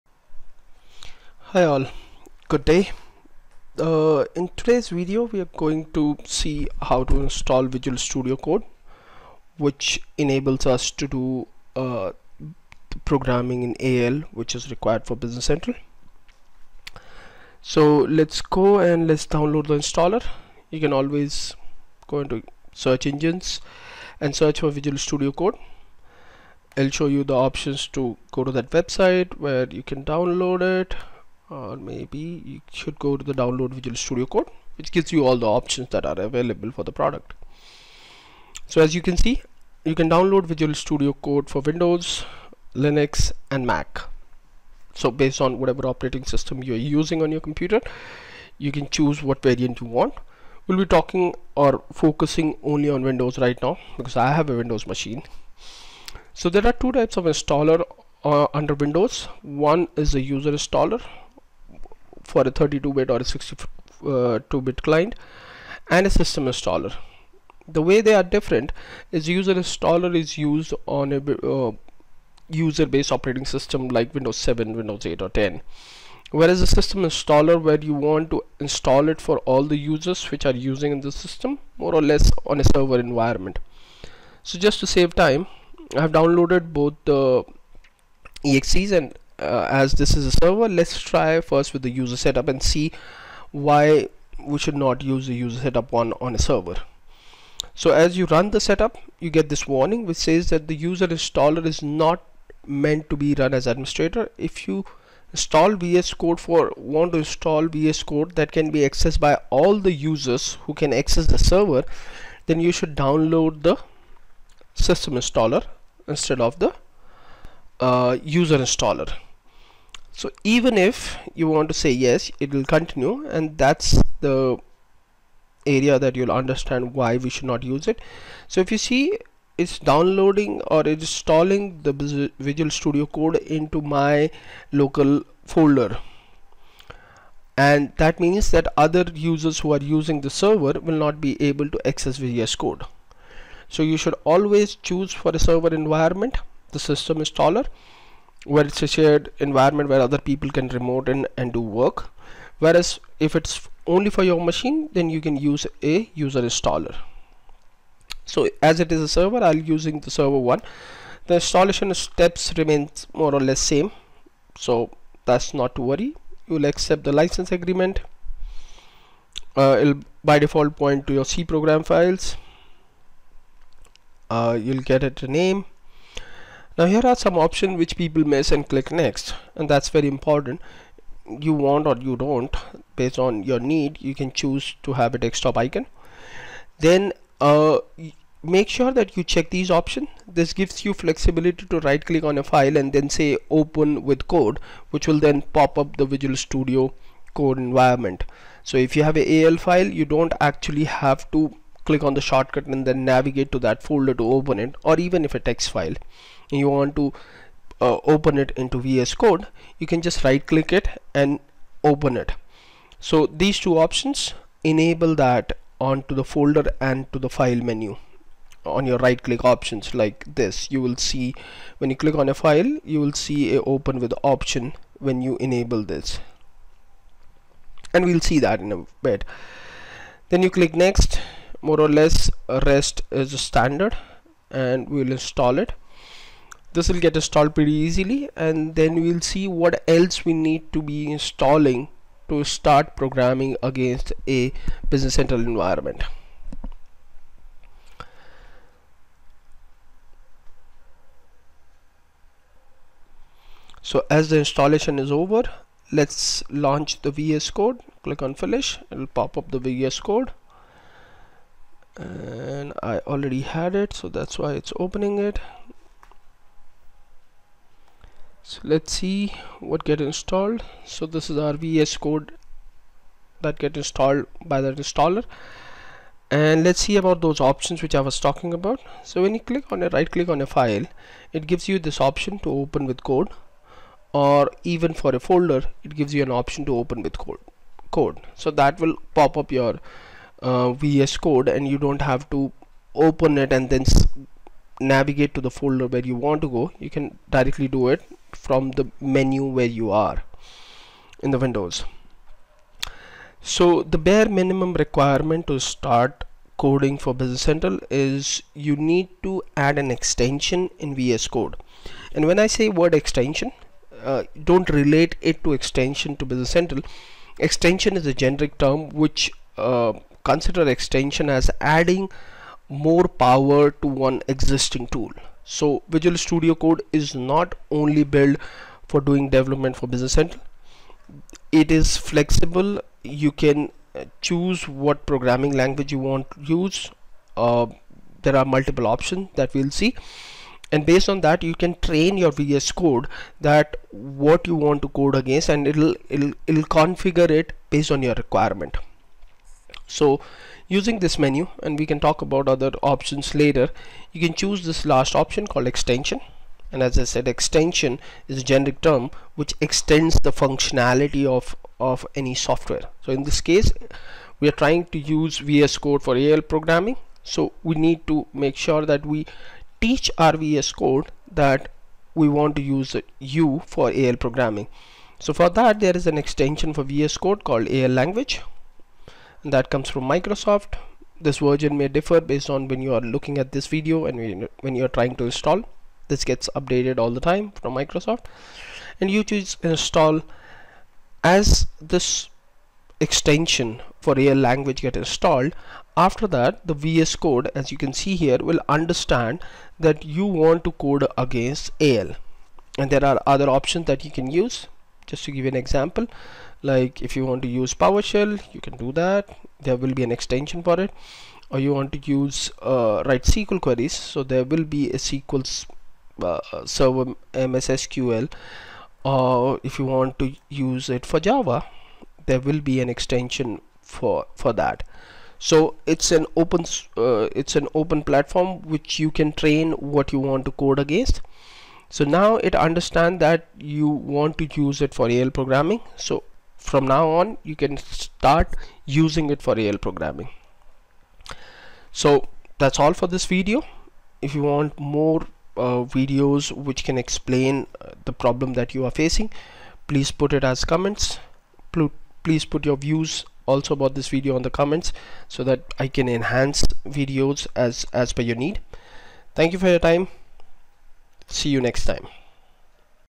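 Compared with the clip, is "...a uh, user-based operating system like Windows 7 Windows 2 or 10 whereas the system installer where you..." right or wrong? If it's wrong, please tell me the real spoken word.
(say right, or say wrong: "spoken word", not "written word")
wrong: "8", not "2".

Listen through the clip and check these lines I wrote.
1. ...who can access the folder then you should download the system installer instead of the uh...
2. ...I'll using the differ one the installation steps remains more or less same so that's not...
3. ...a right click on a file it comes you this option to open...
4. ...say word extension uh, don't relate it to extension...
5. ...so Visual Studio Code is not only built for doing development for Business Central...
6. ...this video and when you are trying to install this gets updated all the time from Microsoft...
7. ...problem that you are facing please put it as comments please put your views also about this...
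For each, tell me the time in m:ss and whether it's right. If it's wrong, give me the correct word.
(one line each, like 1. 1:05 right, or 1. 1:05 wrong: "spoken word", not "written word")
1. 1:50 wrong: "server", not "folder"
2. 2:39 wrong: "server", not "differ"
3. 4:39 wrong: "gives", not "comes"
4. 5:12 right
5. 5:25 right
6. 6:23 right
7. 7:28 right.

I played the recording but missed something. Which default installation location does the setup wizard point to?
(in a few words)
C program files.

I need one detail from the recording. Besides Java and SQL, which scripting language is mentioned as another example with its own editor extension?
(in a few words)
PowerShell.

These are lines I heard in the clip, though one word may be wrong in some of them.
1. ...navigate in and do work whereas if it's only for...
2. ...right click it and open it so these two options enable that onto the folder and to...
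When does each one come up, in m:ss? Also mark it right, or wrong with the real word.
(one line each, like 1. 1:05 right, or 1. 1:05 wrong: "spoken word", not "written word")
1. 2:30 wrong: "remote", not "navigate"
2. 3:30 right.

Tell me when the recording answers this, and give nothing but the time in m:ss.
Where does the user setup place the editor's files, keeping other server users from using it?
2:14.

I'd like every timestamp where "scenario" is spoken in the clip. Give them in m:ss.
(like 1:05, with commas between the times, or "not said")
not said.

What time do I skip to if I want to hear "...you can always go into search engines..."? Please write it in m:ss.
0:20.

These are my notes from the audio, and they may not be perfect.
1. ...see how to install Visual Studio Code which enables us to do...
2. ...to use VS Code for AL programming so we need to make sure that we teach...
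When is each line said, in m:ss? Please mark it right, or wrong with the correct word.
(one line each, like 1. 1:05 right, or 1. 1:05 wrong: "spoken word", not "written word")
1. 0:06 right
2. 6:04 right.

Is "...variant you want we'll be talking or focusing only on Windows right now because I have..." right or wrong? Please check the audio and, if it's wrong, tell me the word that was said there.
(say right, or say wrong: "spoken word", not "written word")
right.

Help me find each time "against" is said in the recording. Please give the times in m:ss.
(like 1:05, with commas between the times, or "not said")
4:03, 5:45, 6:41, 7:10.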